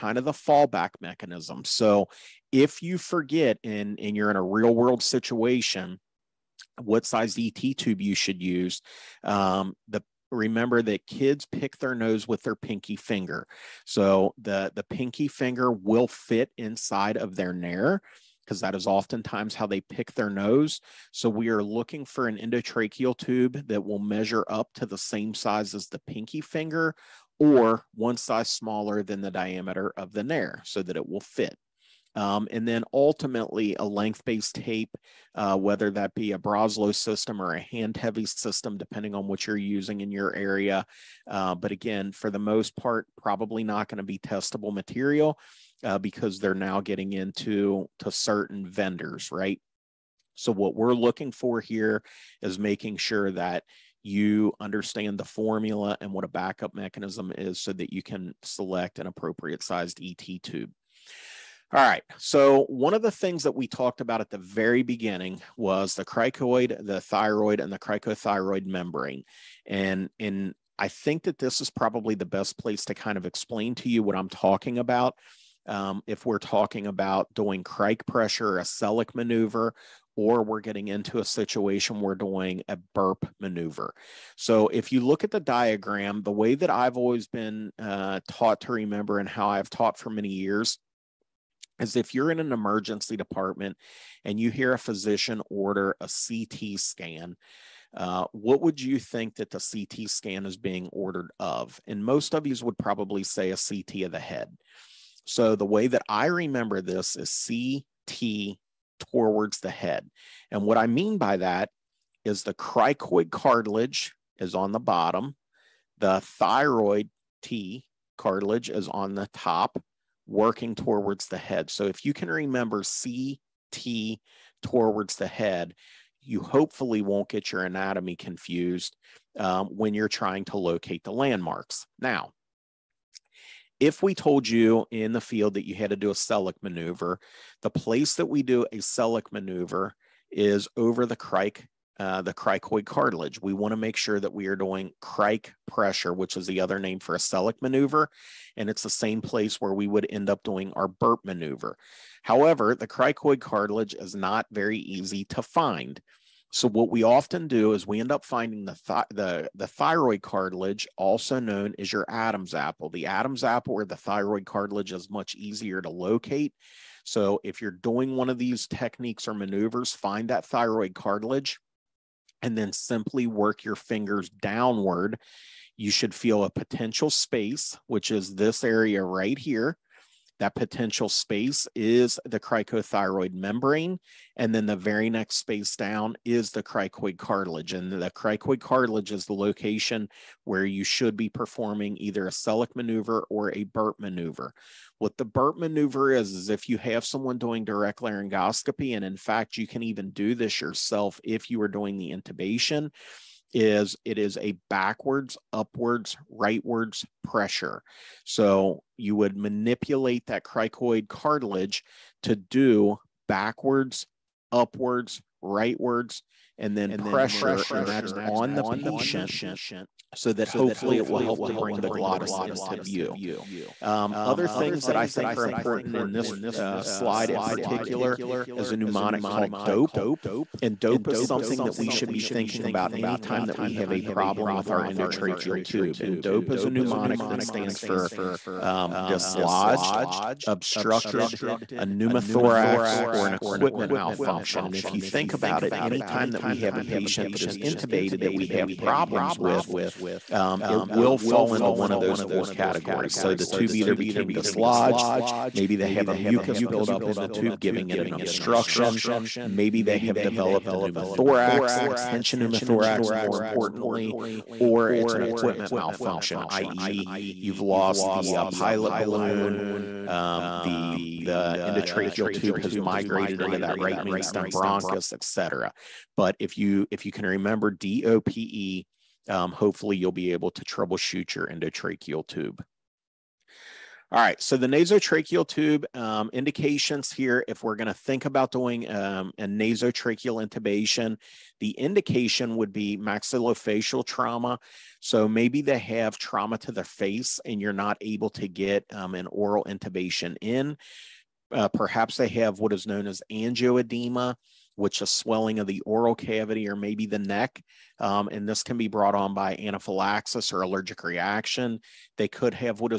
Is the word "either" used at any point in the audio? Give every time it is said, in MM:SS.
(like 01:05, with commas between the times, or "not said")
03:11, 04:13.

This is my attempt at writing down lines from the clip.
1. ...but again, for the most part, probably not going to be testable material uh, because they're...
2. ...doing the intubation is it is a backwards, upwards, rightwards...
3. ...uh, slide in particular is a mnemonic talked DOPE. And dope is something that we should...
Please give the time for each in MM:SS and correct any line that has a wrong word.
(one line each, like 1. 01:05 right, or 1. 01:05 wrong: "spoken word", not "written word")
1. 00:41 right
2. 03:21 right
3. 03:46 wrong: "called", not "talked".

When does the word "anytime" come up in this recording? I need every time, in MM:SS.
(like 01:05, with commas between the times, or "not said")
03:52, 04:05.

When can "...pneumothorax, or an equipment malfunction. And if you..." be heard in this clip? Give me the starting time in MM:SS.
04:01.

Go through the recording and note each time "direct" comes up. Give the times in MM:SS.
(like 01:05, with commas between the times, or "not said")
03:17.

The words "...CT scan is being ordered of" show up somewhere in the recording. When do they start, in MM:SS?
01:39.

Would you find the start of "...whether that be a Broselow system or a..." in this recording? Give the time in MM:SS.
00:35.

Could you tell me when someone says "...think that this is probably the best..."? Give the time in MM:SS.
01:10.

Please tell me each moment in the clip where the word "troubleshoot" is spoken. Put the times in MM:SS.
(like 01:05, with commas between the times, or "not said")
04:40.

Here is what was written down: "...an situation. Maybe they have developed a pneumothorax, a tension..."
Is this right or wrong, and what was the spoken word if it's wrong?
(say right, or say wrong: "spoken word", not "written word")
wrong: "obstruction", not "situation".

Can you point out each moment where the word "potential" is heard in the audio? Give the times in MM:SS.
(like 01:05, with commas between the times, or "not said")
02:56, 03:00.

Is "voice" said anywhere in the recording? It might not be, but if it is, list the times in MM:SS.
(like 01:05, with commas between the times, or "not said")
not said.